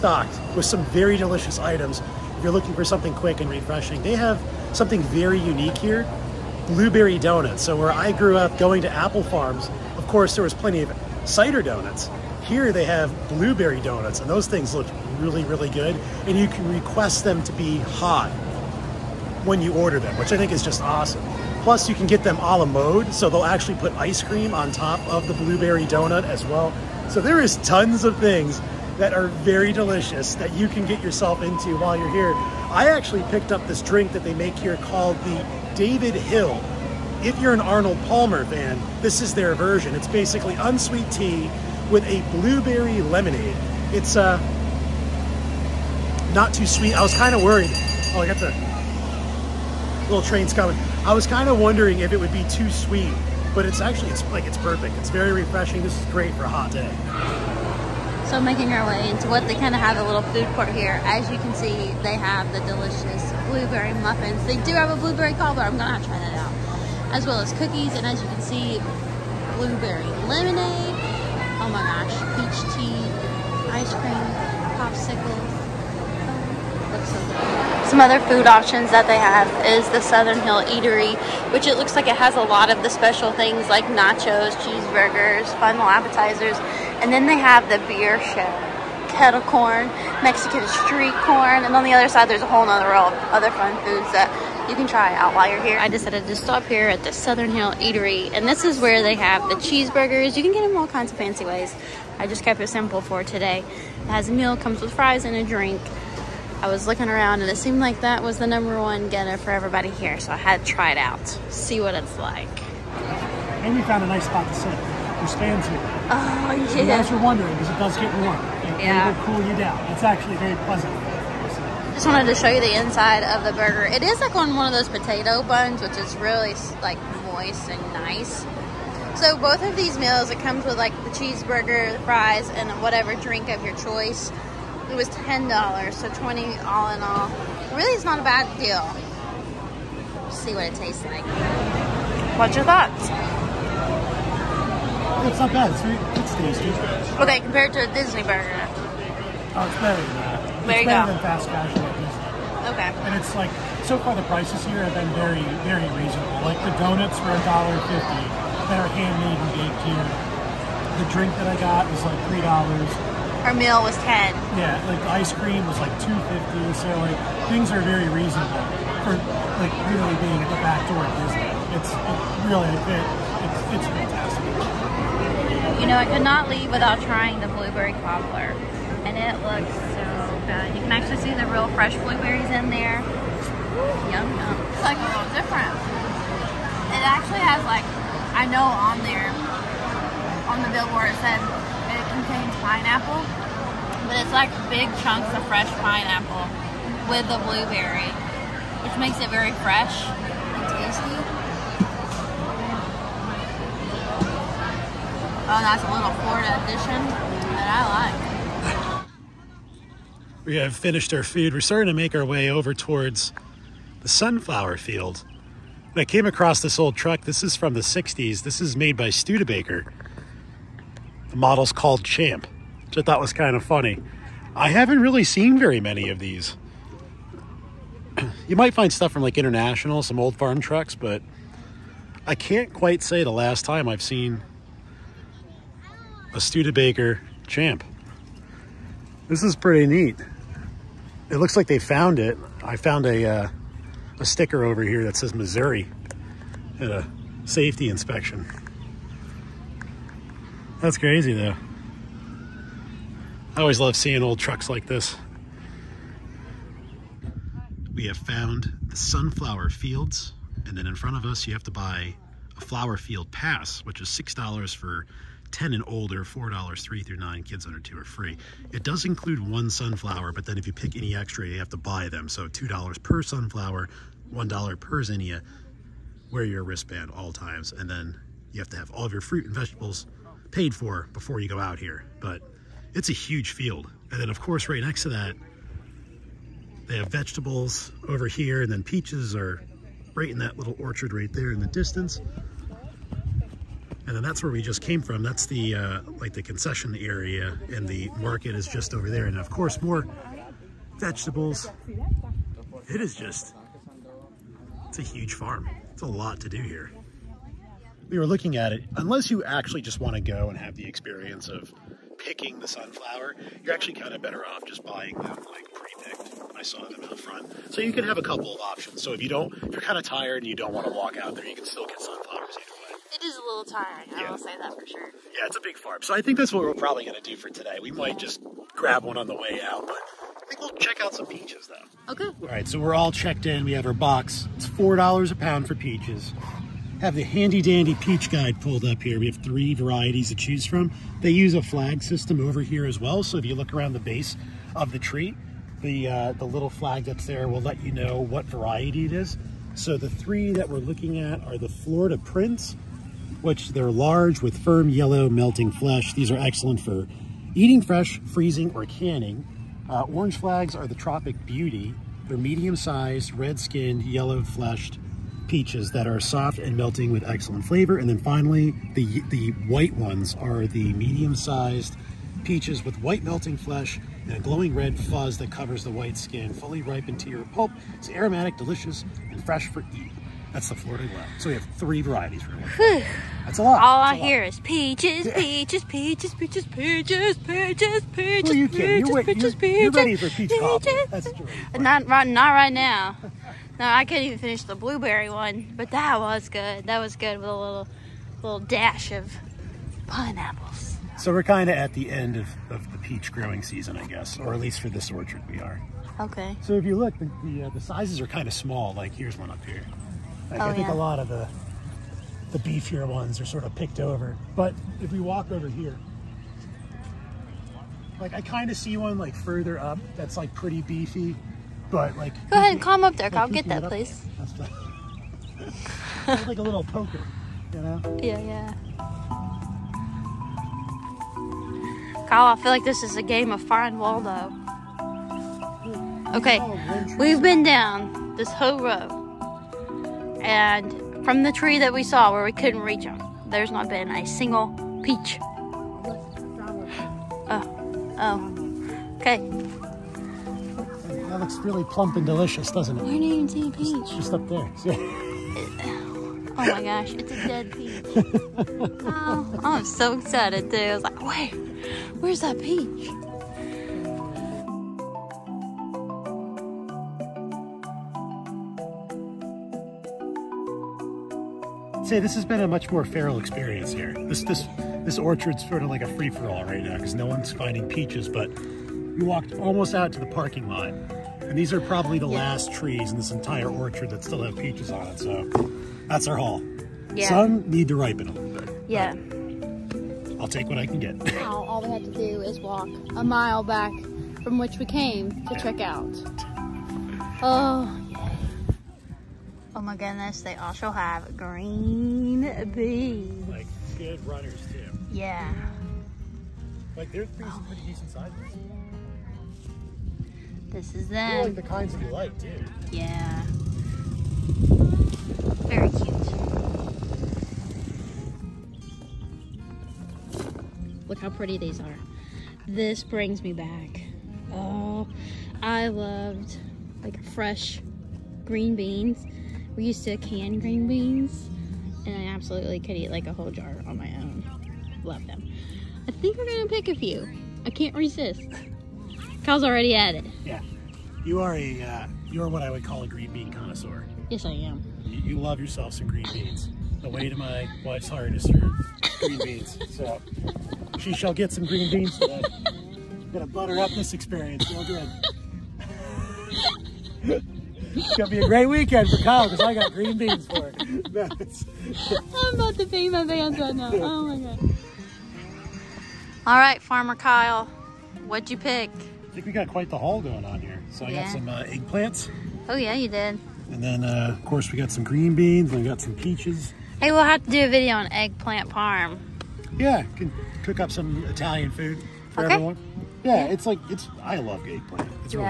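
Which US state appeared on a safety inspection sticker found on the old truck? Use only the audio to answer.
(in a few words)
Missouri.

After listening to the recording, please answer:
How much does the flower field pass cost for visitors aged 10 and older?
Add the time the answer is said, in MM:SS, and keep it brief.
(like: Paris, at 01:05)
$6, at 04:24.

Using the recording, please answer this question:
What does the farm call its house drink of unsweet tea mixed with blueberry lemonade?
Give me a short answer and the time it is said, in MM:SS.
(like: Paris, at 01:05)
David Hill, at 00:35.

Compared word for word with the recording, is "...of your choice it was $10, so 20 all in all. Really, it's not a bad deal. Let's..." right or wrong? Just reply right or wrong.
right.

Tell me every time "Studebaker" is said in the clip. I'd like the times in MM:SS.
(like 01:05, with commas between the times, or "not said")
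03:39, 03:56.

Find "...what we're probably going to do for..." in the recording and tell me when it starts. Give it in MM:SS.
05:26.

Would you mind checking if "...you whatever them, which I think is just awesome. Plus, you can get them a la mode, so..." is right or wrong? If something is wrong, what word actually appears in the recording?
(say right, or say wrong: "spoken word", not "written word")
wrong: "order", not "whatever".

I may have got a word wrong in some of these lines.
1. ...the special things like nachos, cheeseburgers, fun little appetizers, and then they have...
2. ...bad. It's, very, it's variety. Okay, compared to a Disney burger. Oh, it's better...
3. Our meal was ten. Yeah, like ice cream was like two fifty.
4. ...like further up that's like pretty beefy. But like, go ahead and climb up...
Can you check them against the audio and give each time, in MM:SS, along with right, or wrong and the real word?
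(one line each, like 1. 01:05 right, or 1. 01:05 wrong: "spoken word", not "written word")
1. 01:22 right
2. 02:25 wrong: "tasty", not "variety"
3. 02:43 right
4. 06:59 right.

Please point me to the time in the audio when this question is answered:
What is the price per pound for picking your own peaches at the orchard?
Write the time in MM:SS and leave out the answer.
05:34.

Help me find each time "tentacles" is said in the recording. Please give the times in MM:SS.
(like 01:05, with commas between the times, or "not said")
not said.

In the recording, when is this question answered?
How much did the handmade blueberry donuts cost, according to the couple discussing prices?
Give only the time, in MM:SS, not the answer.
02:37.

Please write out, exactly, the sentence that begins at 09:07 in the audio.
The way to my wife's heart is through green beans.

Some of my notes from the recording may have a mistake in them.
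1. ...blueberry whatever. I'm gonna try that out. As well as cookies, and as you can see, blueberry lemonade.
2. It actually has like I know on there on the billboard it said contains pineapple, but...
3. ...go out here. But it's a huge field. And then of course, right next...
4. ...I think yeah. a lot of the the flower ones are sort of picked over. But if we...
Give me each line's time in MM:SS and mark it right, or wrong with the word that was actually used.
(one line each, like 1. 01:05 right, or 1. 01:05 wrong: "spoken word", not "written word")
1. 01:05 wrong: "cobbler", not "whatever"
2. 03:06 right
3. 04:41 right
4. 06:50 wrong: "beefier", not "flower".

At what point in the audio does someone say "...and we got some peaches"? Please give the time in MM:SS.
09:35.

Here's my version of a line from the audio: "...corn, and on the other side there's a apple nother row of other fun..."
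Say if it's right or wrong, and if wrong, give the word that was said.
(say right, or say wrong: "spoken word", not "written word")
wrong: "whole", not "apple".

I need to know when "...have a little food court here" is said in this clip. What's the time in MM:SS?
00:59.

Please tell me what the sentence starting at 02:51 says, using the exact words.
It's it really it, it's it's fantastic.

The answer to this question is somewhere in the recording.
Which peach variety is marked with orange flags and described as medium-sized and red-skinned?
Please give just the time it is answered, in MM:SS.
06:00.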